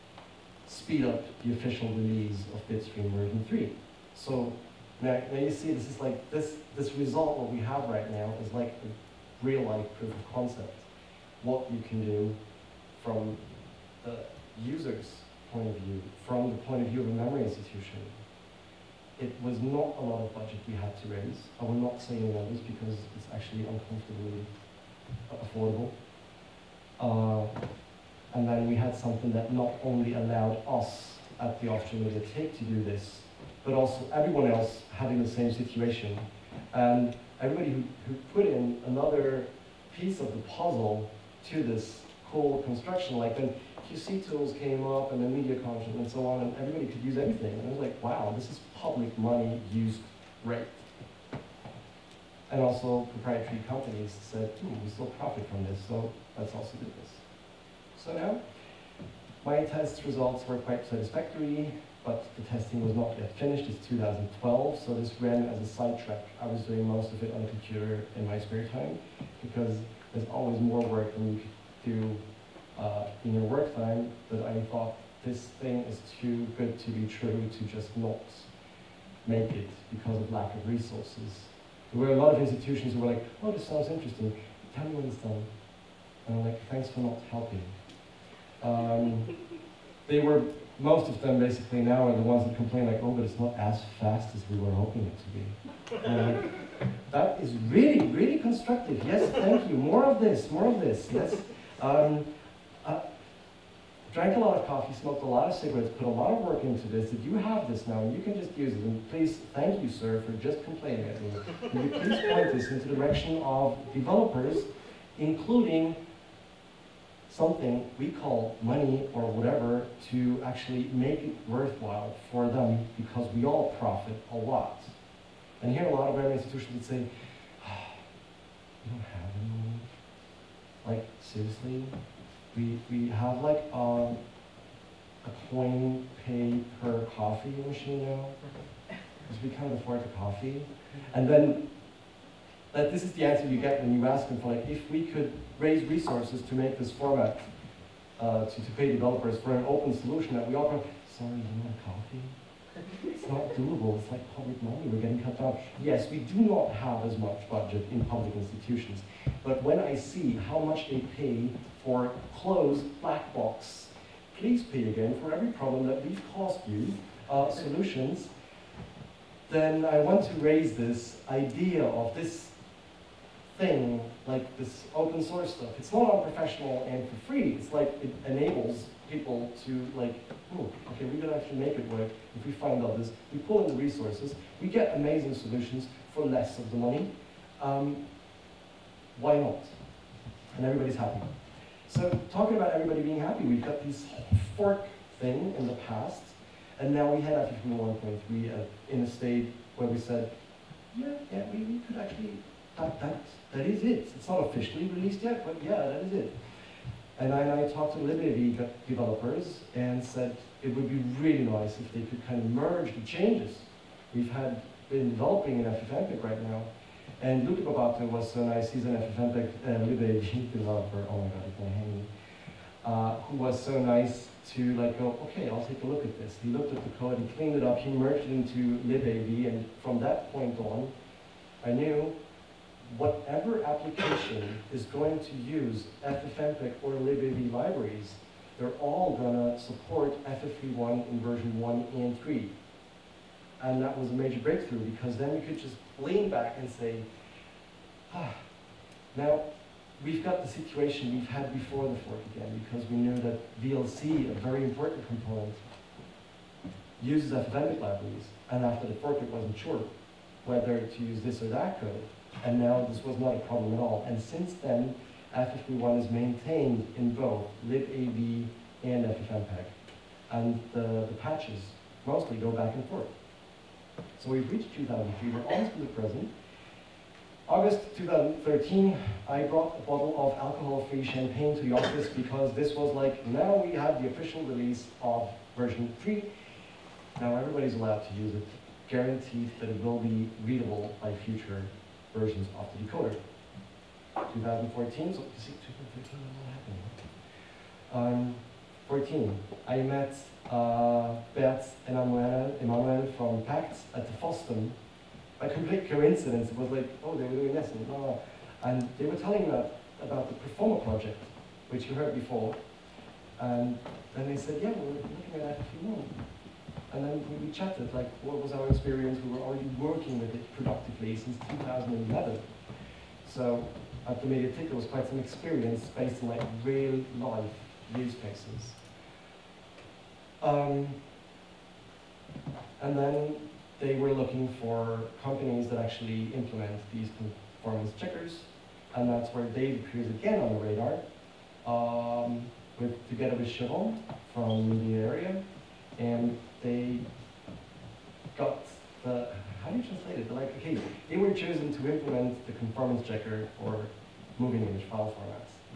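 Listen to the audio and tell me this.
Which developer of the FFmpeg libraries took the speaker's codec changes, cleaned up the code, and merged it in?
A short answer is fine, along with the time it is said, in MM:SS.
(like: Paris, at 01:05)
Luca Barbato, at 03:37.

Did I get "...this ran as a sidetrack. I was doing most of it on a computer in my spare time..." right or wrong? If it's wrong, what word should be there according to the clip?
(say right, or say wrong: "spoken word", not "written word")
right.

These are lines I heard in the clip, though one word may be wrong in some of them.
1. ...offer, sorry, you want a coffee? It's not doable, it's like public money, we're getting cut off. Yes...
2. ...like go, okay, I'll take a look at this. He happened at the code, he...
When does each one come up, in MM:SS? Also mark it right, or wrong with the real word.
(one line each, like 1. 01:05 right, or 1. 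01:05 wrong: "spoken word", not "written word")
1. 02:30 right
2. 03:44 wrong: "looked", not "happened".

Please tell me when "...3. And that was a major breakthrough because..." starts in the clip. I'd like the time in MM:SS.
04:02.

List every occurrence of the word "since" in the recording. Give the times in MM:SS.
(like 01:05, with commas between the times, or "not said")
04:24, 05:21.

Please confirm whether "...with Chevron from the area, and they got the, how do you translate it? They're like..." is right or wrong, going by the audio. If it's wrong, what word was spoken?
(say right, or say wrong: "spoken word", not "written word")
right.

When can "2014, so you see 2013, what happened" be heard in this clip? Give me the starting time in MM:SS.
04:54.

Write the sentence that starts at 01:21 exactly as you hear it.
There were a lot of institutions who were like, oh, this sounds interesting.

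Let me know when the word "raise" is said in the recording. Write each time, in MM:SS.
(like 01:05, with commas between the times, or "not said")
00:21, 02:25, 02:50.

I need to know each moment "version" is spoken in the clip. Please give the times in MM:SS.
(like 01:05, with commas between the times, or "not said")
00:03, 04:01, 04:45, 04:52.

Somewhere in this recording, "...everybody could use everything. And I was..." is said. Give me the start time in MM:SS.
00:46.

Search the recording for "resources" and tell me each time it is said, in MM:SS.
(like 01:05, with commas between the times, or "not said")
01:20, 02:25, 03:03.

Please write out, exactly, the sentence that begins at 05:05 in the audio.
By complete coincidence, it was like, oh, they were doing this and blah, blah.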